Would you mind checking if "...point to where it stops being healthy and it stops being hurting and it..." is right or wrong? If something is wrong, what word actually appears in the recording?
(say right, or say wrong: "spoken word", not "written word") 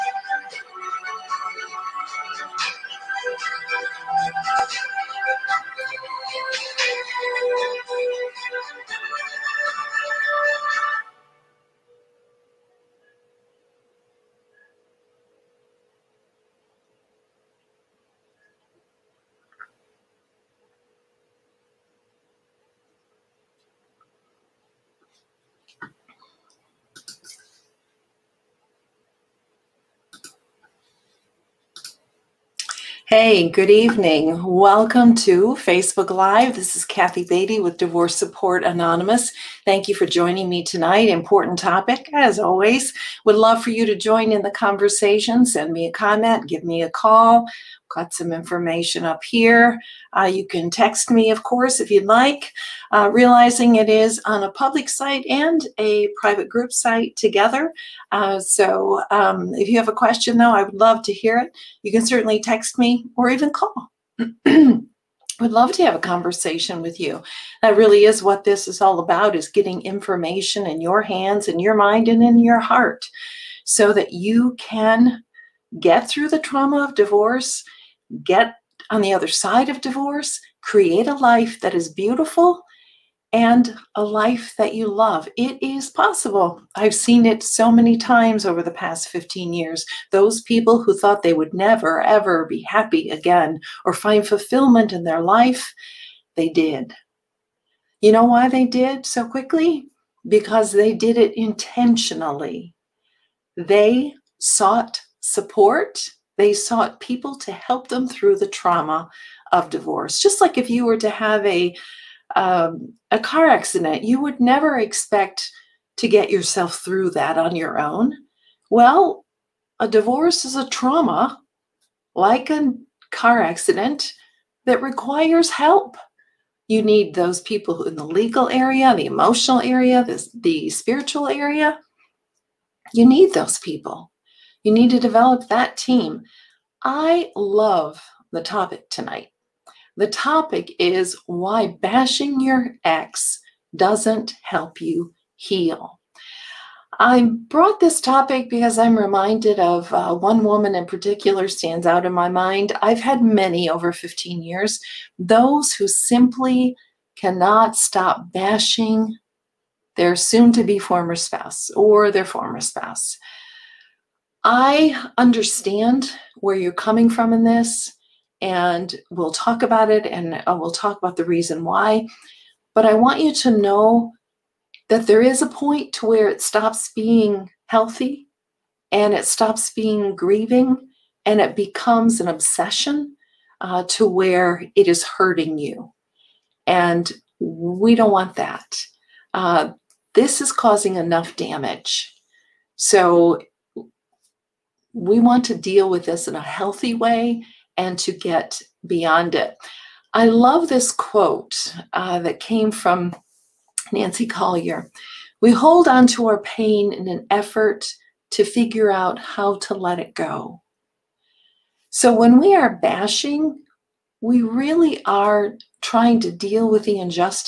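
wrong: "grieving", not "hurting".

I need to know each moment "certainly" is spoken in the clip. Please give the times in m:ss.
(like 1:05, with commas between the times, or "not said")
1:02.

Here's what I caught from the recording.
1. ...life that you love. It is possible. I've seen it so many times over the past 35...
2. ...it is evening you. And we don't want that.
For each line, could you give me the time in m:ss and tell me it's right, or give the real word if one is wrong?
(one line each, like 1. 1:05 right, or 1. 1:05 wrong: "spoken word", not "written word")
1. 1:24 wrong: "15", not "35"
2. 3:04 wrong: "hurting", not "evening".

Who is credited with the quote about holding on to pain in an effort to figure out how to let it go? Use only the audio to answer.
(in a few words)
Nancy Collier.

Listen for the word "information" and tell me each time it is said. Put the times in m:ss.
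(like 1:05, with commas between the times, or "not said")
0:48, 1:09.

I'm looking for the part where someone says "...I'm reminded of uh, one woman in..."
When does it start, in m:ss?
2:28.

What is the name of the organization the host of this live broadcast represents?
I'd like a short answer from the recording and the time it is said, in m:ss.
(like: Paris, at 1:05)
Divorce Support Anonymous, at 0:37.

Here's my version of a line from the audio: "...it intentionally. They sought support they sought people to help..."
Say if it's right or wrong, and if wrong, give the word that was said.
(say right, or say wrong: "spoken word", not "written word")
right.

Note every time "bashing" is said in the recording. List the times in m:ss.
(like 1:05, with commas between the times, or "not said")
2:21, 2:38, 3:32.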